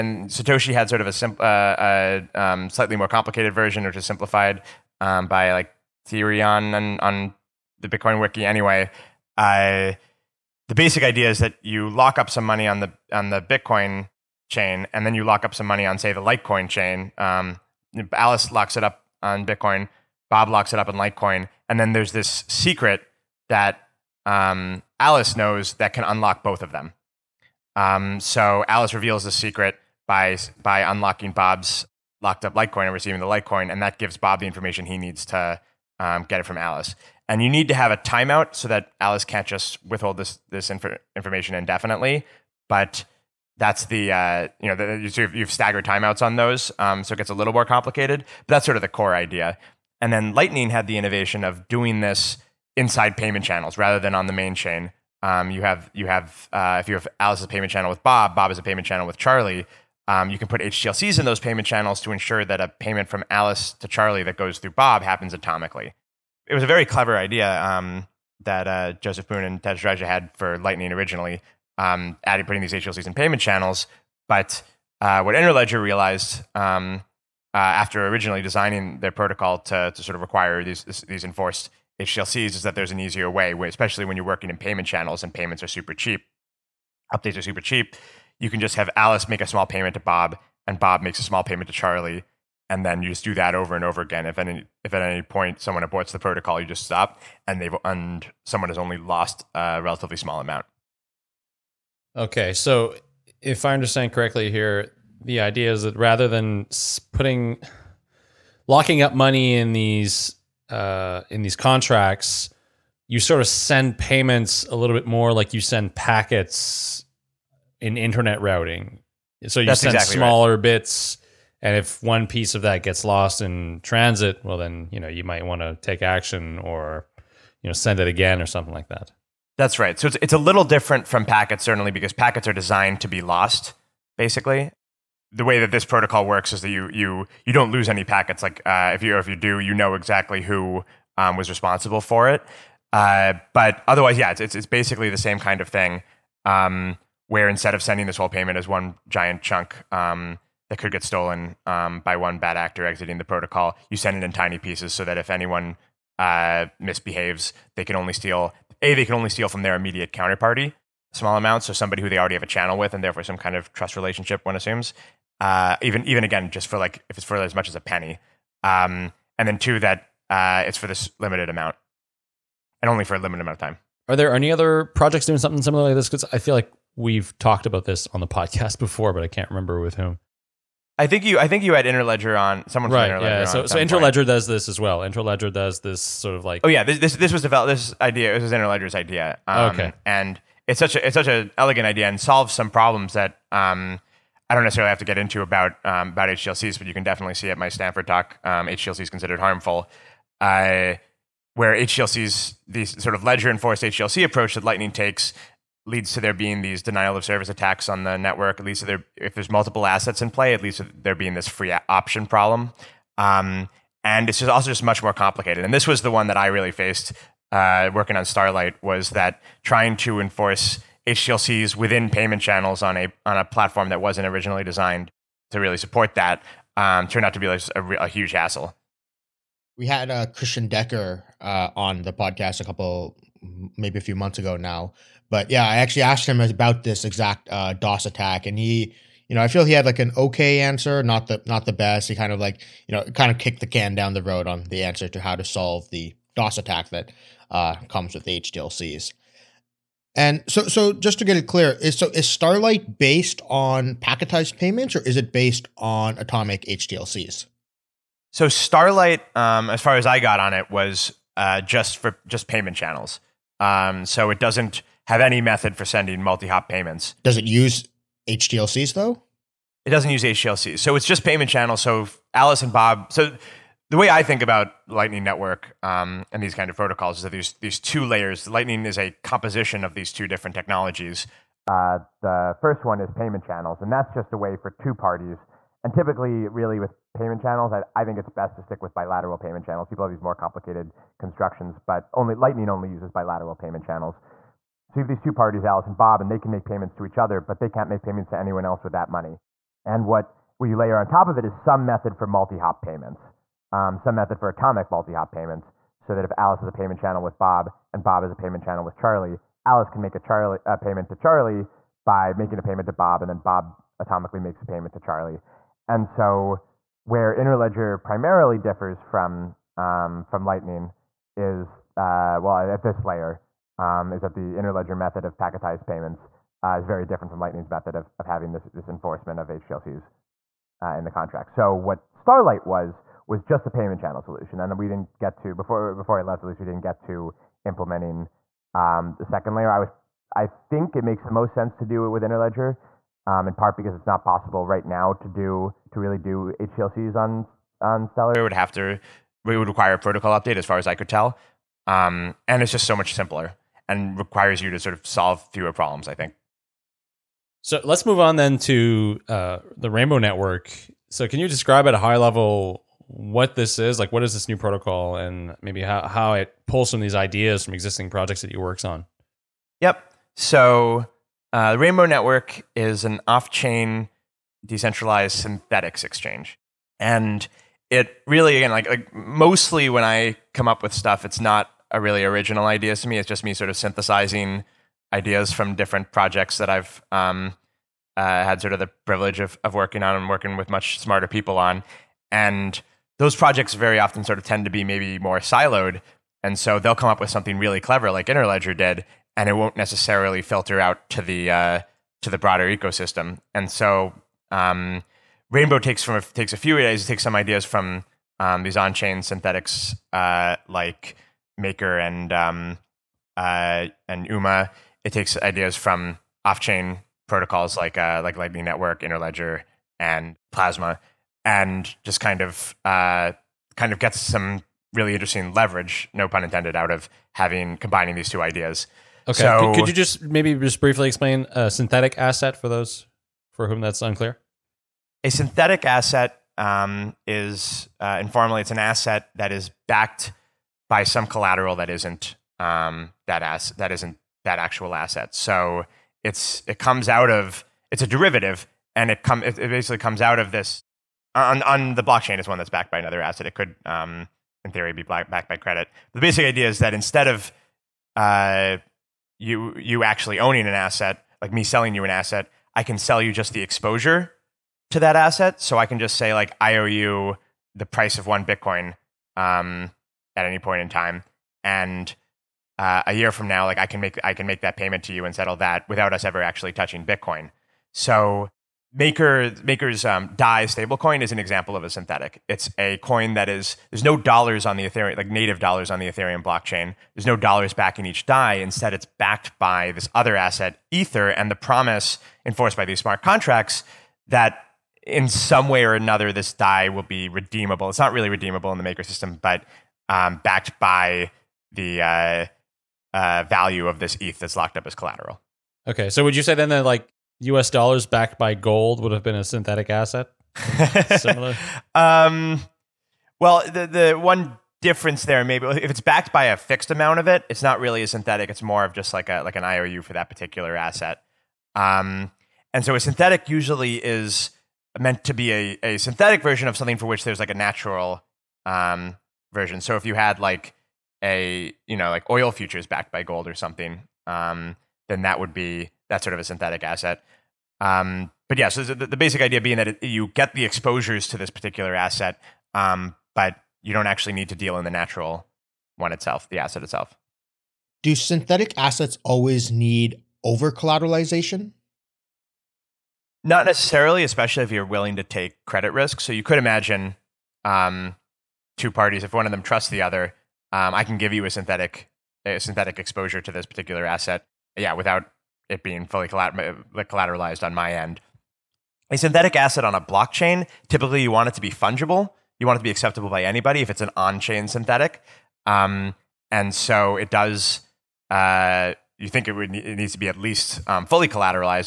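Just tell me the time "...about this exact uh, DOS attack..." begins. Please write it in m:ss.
3:56.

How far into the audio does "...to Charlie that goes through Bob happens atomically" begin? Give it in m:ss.
1:03.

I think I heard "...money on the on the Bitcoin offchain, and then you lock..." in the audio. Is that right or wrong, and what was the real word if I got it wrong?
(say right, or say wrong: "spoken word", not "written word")
wrong: "chain", not "offchain".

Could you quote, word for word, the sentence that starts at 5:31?
So what Starlight was was just a payment channel solution, and we didn't get to before before I left.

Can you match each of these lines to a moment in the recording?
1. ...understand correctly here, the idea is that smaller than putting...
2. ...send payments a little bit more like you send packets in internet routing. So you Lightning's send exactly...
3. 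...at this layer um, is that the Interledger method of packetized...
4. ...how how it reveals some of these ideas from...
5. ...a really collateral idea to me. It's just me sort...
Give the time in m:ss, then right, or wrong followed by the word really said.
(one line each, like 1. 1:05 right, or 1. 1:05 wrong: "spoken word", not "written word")
1. 1:43 wrong: "rather", not "smaller"
2. 1:53 wrong: "That", not "Lightning"
3. 5:22 right
4. 6:05 wrong: "pulls", not "reveals"
5. 6:21 wrong: "original", not "collateral".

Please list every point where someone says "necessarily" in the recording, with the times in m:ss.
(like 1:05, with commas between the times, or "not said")
3:14, 6:39, 9:13.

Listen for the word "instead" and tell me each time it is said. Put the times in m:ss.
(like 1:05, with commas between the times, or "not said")
2:27, 7:36, 8:08.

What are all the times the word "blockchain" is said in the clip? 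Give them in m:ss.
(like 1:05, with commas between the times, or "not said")
7:32, 8:06, 9:30.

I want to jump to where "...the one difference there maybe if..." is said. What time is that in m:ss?
8:34.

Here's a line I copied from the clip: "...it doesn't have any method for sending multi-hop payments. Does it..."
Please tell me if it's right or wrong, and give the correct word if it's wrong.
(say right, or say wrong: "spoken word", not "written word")
right.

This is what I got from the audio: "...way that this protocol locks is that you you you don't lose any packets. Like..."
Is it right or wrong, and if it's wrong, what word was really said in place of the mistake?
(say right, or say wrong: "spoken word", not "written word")
wrong: "works", not "locks".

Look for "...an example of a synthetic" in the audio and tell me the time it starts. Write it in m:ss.
8:01.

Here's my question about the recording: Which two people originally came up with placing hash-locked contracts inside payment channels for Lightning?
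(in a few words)
Joseph Poon and Tadge Dryja.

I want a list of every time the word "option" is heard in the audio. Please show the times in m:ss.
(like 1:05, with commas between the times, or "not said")
3:31.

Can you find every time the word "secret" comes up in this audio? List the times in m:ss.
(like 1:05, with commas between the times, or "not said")
0:22, 0:29.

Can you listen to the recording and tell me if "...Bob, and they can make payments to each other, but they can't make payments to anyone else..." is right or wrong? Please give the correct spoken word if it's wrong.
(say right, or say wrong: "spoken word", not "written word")
right.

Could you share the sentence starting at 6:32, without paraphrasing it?
And those projects very often sort of tend to be maybe more siloed.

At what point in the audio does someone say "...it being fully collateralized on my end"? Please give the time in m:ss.
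9:25.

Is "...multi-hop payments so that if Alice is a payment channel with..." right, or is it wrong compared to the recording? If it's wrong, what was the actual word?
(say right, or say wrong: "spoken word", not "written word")
right.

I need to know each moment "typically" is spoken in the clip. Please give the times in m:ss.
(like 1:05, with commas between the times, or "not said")
4:45, 9:30.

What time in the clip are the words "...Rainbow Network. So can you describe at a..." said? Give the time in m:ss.
5:59.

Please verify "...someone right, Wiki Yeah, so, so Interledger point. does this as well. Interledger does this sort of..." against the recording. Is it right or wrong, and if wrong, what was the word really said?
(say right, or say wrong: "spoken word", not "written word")
wrong: "Interledger", not "Wiki".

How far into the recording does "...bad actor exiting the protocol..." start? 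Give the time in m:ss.
2:32.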